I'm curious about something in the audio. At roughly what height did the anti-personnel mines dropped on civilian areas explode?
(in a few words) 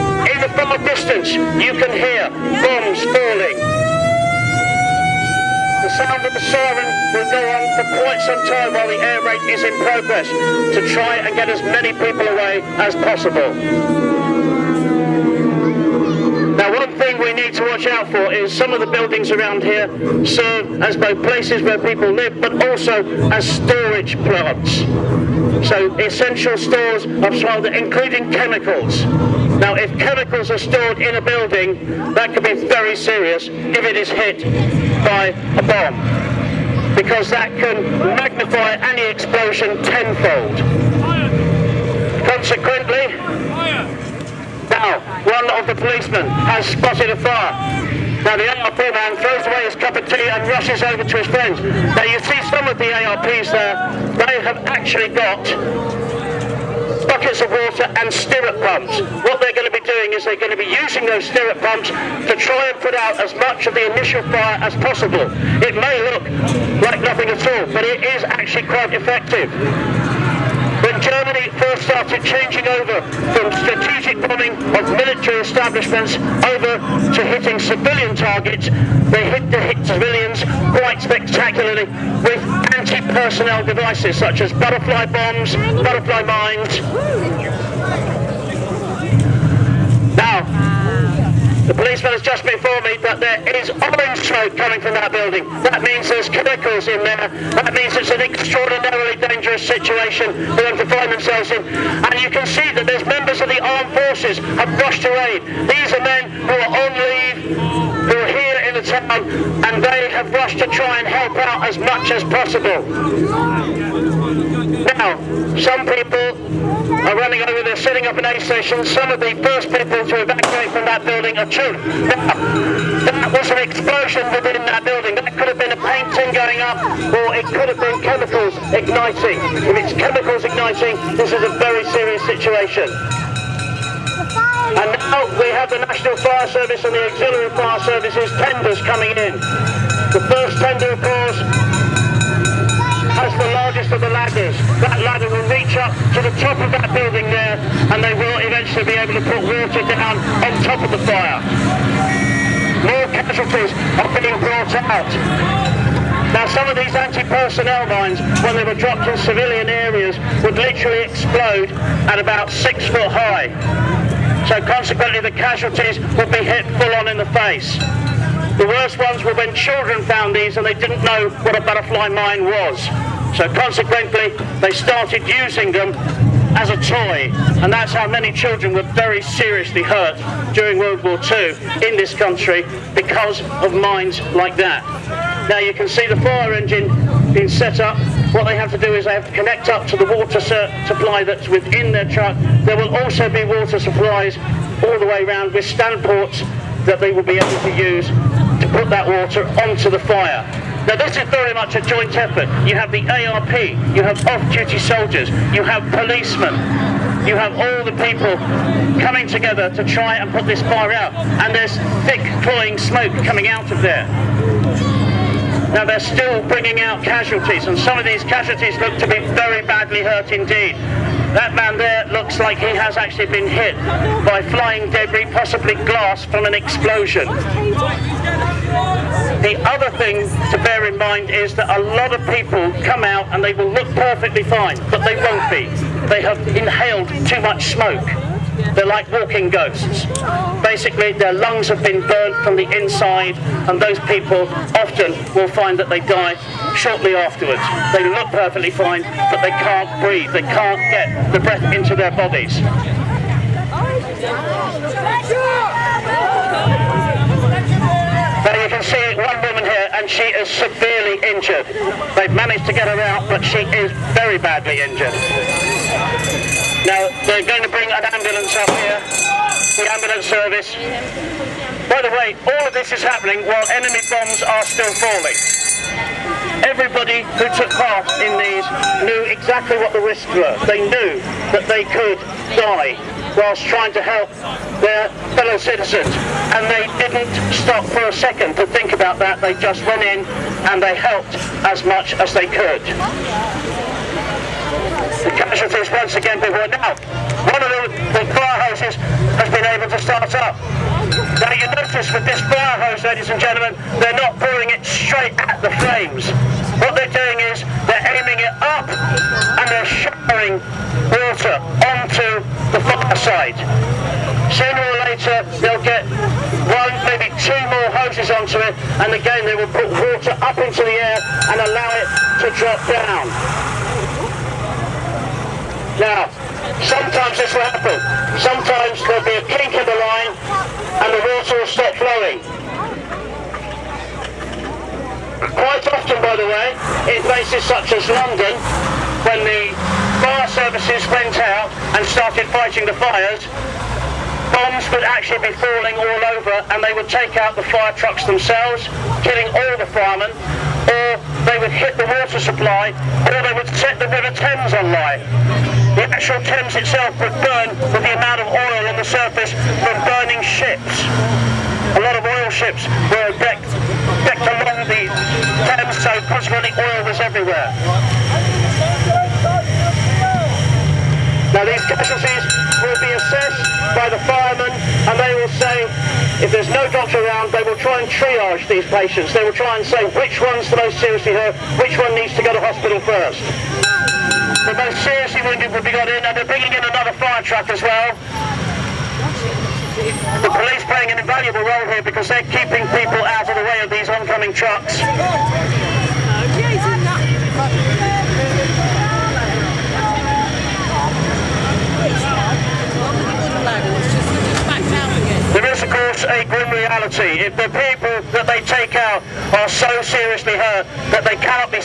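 6 foot.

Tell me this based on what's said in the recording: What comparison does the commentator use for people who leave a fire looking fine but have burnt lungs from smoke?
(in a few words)
walking ghosts.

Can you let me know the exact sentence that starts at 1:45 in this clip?
These are men who are on leave and they have rushed to try and help out as much as possible.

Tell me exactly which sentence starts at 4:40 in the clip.
They knew that they could die whilst trying to help their fellow citizens.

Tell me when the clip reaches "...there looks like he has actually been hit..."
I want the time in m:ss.
3:41.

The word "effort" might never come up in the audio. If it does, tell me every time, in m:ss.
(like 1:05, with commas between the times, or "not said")
3:22.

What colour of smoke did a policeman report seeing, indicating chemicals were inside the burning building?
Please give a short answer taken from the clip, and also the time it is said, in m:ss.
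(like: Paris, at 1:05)
orange, at 1:33.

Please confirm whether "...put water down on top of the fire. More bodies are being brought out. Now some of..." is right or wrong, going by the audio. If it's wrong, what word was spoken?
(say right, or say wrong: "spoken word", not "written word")
wrong: "casualties", not "bodies".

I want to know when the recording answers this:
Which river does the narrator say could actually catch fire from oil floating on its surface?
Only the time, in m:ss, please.
5:54.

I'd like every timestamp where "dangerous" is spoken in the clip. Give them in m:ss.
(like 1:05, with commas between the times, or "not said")
1:39.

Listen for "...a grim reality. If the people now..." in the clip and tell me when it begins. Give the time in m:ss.
6:46.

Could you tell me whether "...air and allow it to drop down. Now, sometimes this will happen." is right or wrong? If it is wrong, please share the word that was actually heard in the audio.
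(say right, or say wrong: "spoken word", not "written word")
right.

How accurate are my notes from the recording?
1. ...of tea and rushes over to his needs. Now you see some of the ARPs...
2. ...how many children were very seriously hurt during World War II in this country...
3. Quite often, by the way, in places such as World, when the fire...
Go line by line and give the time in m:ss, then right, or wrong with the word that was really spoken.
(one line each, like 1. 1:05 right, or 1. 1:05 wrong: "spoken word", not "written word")
1. 0:49 wrong: "friends", not "needs"
2. 2:57 right
3. 5:35 wrong: "London", not "World".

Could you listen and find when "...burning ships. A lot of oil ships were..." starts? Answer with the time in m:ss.
6:00.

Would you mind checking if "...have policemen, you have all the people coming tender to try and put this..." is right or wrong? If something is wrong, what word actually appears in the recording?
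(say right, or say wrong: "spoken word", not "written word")
wrong: "together", not "tender".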